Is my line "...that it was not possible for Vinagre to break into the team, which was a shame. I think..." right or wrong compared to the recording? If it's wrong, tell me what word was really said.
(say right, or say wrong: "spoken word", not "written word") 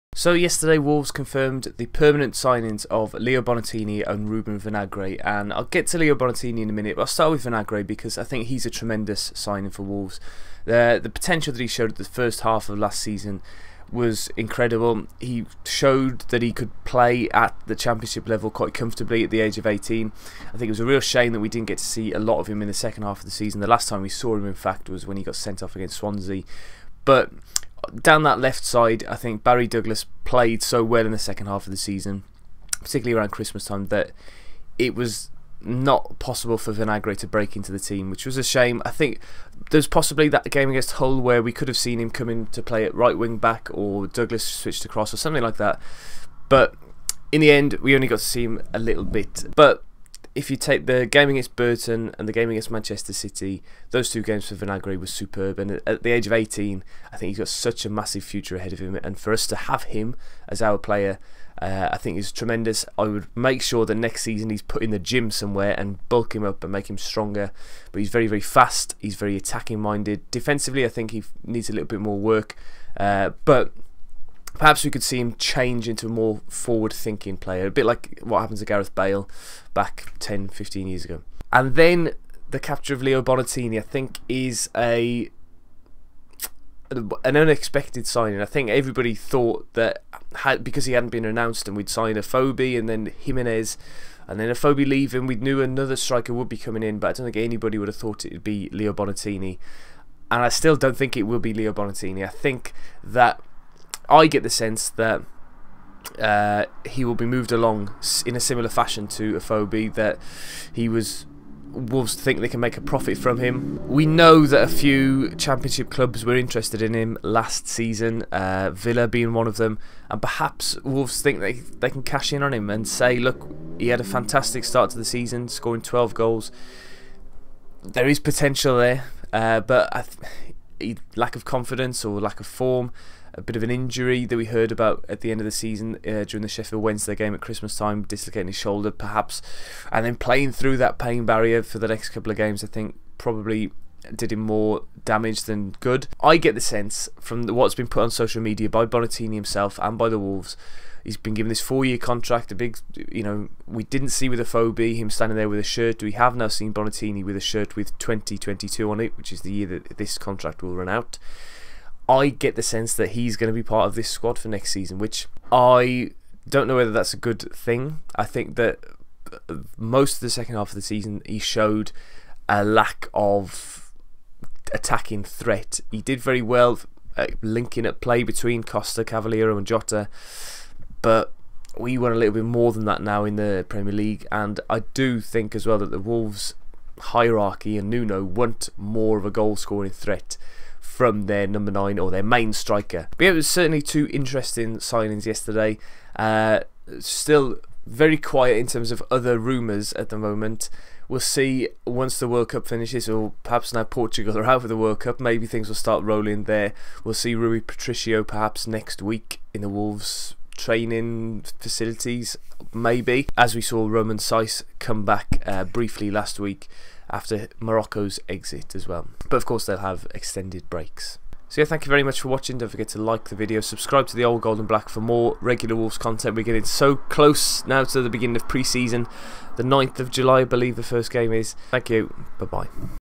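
right.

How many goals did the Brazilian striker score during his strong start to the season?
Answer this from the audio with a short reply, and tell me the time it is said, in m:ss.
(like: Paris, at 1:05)
12, at 2:05.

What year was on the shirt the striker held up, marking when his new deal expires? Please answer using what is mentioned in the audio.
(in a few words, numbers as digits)
2022.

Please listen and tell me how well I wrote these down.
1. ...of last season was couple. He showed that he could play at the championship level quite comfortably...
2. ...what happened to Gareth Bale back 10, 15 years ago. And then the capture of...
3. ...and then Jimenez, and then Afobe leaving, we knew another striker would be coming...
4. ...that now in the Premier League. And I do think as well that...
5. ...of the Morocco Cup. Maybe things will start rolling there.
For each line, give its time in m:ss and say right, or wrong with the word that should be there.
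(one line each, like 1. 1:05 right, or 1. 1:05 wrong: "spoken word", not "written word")
1. 0:12 wrong: "incredible", not "couple"
2. 1:18 right
3. 1:32 right
4. 3:02 right
5. 3:24 wrong: "World", not "Morocco".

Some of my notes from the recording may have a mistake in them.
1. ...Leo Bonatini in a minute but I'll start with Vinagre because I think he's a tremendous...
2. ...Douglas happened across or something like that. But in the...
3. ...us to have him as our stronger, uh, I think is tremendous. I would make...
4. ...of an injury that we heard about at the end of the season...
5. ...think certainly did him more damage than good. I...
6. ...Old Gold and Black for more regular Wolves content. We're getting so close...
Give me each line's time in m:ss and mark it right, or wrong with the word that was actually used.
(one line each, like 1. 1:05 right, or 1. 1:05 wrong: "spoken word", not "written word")
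1. 0:05 right
2. 0:44 wrong: "switched", not "happened"
3. 0:59 wrong: "player", not "stronger"
4. 2:13 right
5. 2:22 wrong: "probably", not "certainly"
6. 3:44 right.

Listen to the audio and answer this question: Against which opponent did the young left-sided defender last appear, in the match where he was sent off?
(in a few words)
Swansea.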